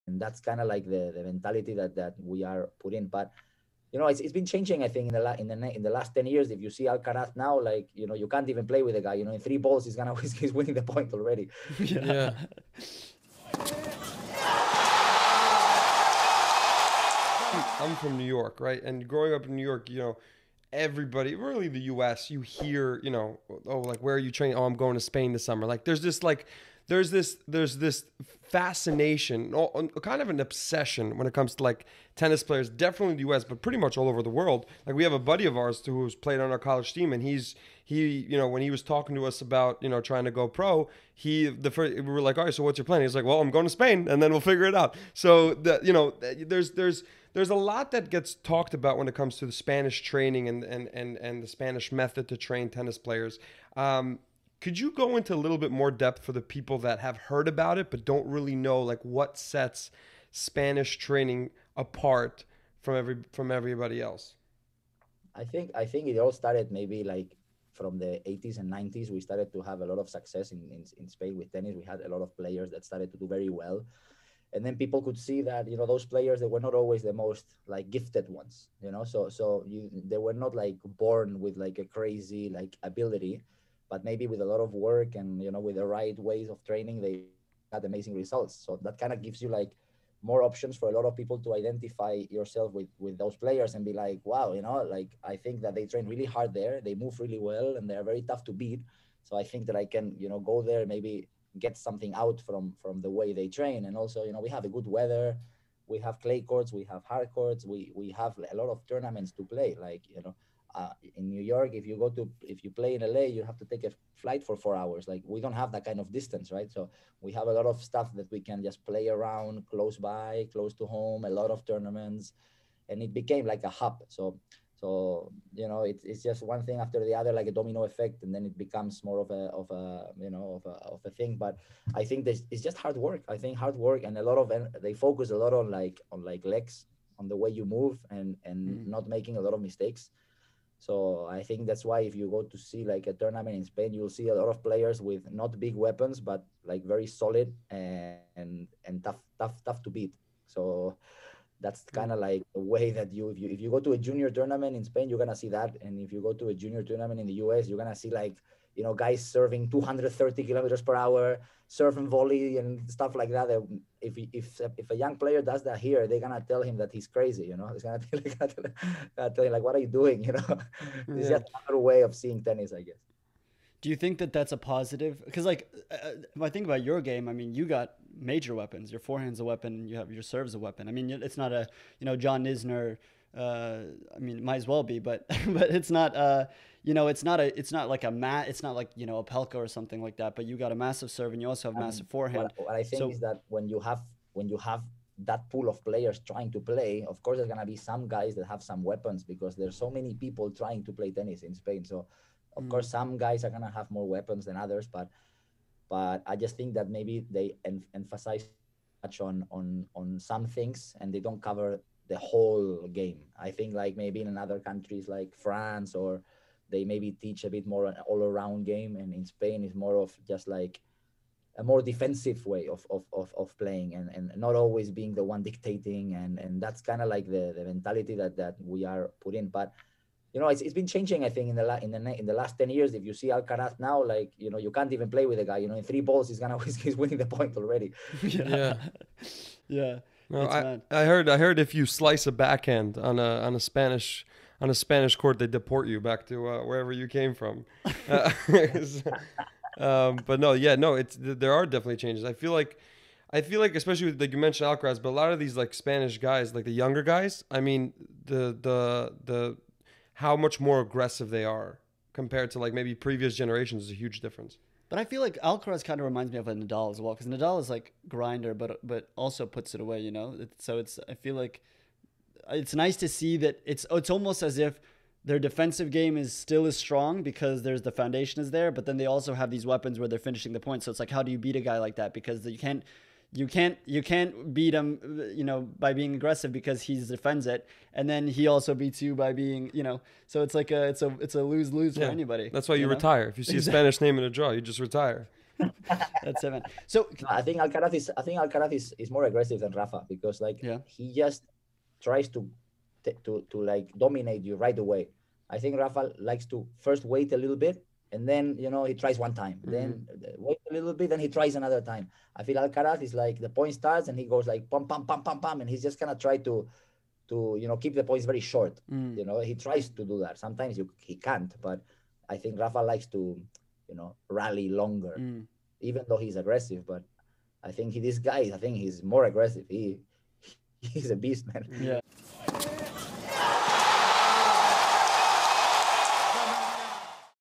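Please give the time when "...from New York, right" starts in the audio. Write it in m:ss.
0:17.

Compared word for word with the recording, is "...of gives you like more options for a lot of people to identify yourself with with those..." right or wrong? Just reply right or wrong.
right.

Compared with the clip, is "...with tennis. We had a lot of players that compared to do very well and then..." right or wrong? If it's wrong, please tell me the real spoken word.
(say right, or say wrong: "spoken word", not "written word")
wrong: "started", not "compared".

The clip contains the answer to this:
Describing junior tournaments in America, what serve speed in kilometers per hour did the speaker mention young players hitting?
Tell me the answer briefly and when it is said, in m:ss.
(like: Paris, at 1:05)
230, at 2:39.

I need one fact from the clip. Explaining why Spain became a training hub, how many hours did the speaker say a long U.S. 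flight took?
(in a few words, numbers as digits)
4.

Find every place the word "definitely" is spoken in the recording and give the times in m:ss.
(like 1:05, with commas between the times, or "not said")
0:32, 4:11.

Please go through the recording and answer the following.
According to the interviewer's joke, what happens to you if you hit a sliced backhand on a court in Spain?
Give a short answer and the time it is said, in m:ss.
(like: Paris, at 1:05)
They deport you, at 4:05.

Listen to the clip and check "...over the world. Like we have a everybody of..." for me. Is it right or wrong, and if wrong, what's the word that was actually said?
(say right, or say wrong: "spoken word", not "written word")
wrong: "buddy", not "everybody".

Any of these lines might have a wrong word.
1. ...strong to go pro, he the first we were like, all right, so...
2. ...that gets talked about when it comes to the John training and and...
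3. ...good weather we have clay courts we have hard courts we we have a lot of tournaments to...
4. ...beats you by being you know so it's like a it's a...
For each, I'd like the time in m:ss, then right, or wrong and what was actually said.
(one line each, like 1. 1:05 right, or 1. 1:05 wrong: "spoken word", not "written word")
1. 0:40 wrong: "trying", not "strong"
2. 0:47 wrong: "Spanish", not "John"
3. 1:44 right
4. 4:48 right.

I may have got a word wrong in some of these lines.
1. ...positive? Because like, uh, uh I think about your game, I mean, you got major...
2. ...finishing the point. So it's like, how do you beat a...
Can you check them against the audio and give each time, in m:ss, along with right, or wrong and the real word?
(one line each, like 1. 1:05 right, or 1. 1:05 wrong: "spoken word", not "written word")
1. 2:54 right
2. 4:40 right.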